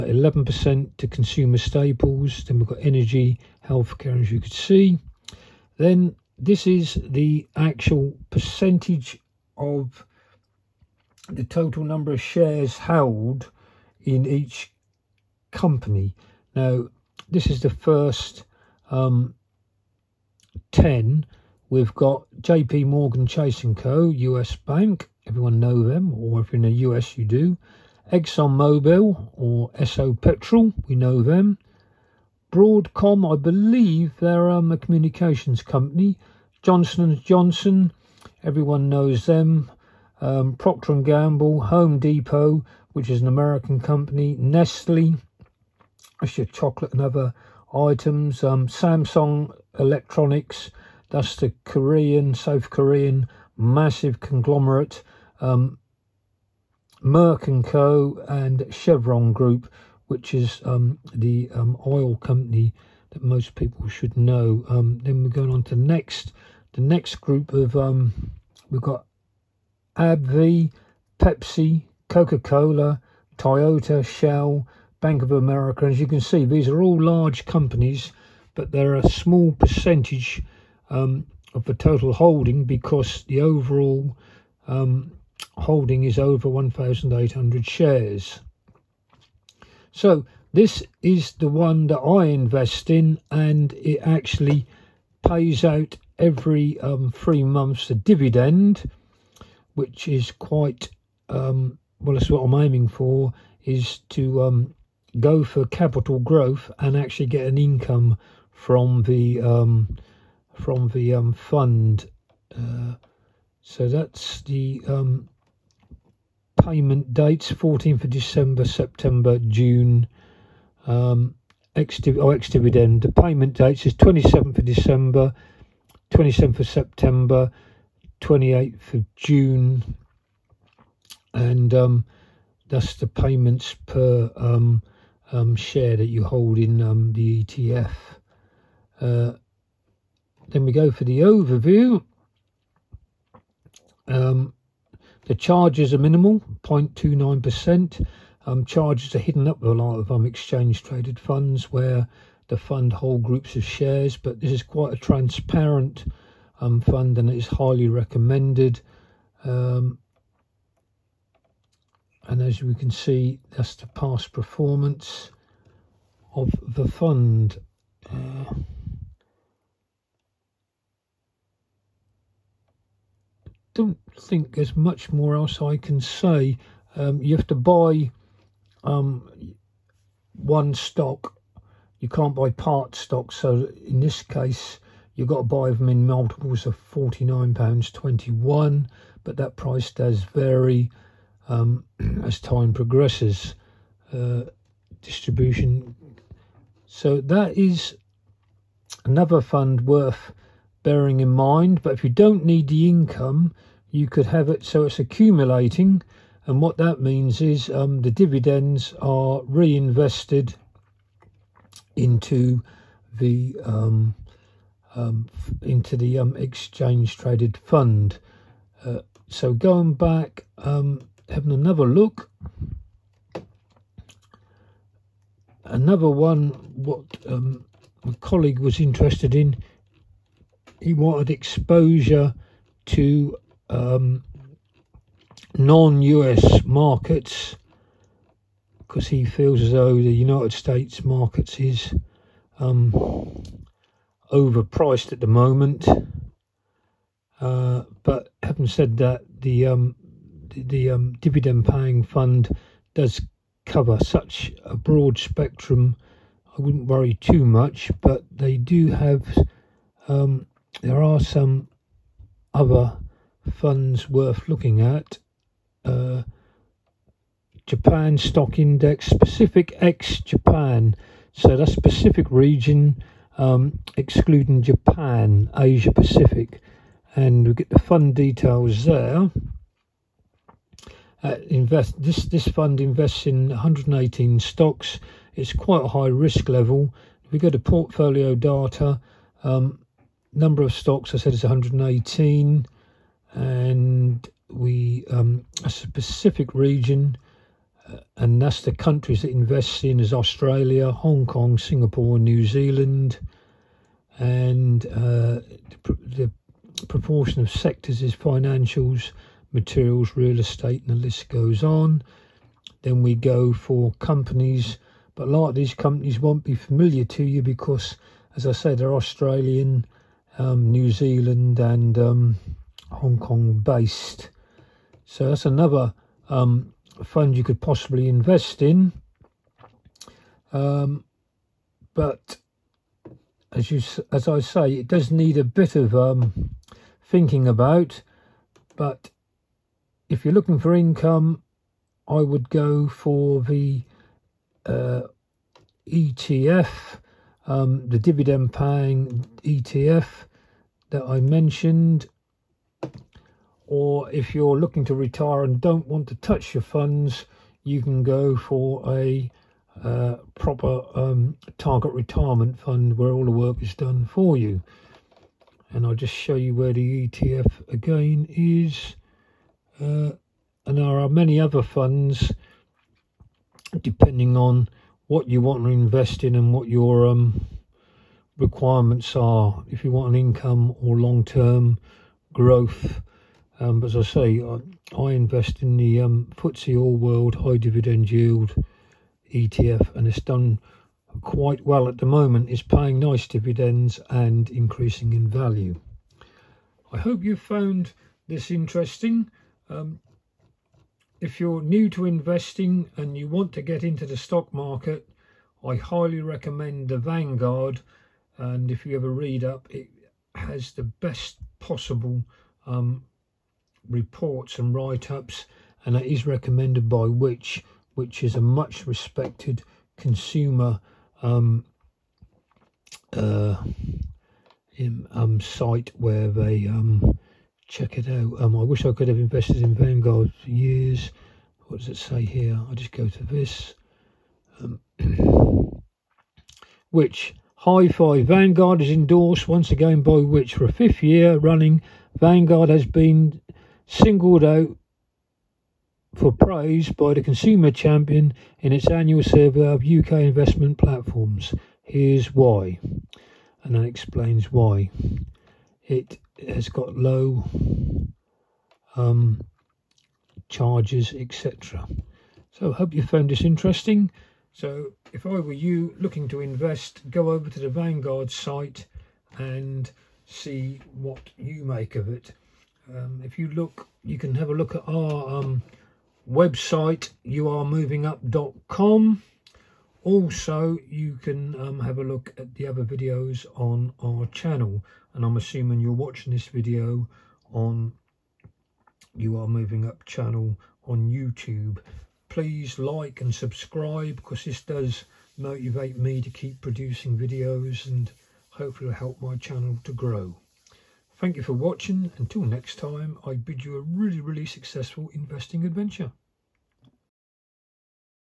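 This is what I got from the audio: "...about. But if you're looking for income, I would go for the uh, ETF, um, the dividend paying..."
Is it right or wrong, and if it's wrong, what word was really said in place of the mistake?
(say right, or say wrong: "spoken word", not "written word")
right.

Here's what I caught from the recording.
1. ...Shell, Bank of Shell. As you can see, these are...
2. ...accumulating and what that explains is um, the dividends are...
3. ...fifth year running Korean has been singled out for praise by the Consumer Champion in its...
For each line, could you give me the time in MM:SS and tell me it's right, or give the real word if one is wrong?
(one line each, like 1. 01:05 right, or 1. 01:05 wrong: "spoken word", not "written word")
1. 01:14 wrong: "America", not "Shell"
2. 03:24 wrong: "means", not "explains"
3. 07:20 wrong: "Vanguard", not "Korean".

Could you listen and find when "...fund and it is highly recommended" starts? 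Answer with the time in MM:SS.
02:36.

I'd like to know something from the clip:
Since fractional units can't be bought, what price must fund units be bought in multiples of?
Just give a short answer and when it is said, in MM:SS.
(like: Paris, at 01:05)
£49.21, at 03:06.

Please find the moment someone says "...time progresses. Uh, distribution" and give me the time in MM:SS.
03:12.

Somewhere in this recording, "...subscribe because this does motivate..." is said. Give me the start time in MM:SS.
08:13.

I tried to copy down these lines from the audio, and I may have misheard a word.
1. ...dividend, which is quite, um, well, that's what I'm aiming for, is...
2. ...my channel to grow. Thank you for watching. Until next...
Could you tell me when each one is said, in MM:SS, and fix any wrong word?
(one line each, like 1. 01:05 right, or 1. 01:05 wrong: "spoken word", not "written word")
1. 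01:37 right
2. 08:19 right.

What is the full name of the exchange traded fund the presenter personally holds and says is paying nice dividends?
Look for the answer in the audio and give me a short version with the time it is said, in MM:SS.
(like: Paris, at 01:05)
FTSE All World High Dividend Yield ETF, at 06:26.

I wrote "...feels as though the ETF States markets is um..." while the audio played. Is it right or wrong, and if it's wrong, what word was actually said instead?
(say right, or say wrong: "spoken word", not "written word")
wrong: "United", not "ETF".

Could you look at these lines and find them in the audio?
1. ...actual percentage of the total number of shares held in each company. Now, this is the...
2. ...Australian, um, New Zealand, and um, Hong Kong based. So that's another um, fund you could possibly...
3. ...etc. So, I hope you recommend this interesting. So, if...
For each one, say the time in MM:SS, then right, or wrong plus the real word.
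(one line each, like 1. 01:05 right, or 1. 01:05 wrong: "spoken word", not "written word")
1. 00:07 right
2. 05:18 right
3. 07:41 wrong: "found", not "recommend".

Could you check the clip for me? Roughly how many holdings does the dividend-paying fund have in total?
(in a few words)
over 1,800.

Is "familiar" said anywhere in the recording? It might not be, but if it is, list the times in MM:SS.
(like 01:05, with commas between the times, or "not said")
05:16.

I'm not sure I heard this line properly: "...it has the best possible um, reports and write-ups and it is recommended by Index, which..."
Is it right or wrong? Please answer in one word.
wrong.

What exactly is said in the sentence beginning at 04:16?
I wouldn't worry too much, but they do have um, there are some other funds worth looking at.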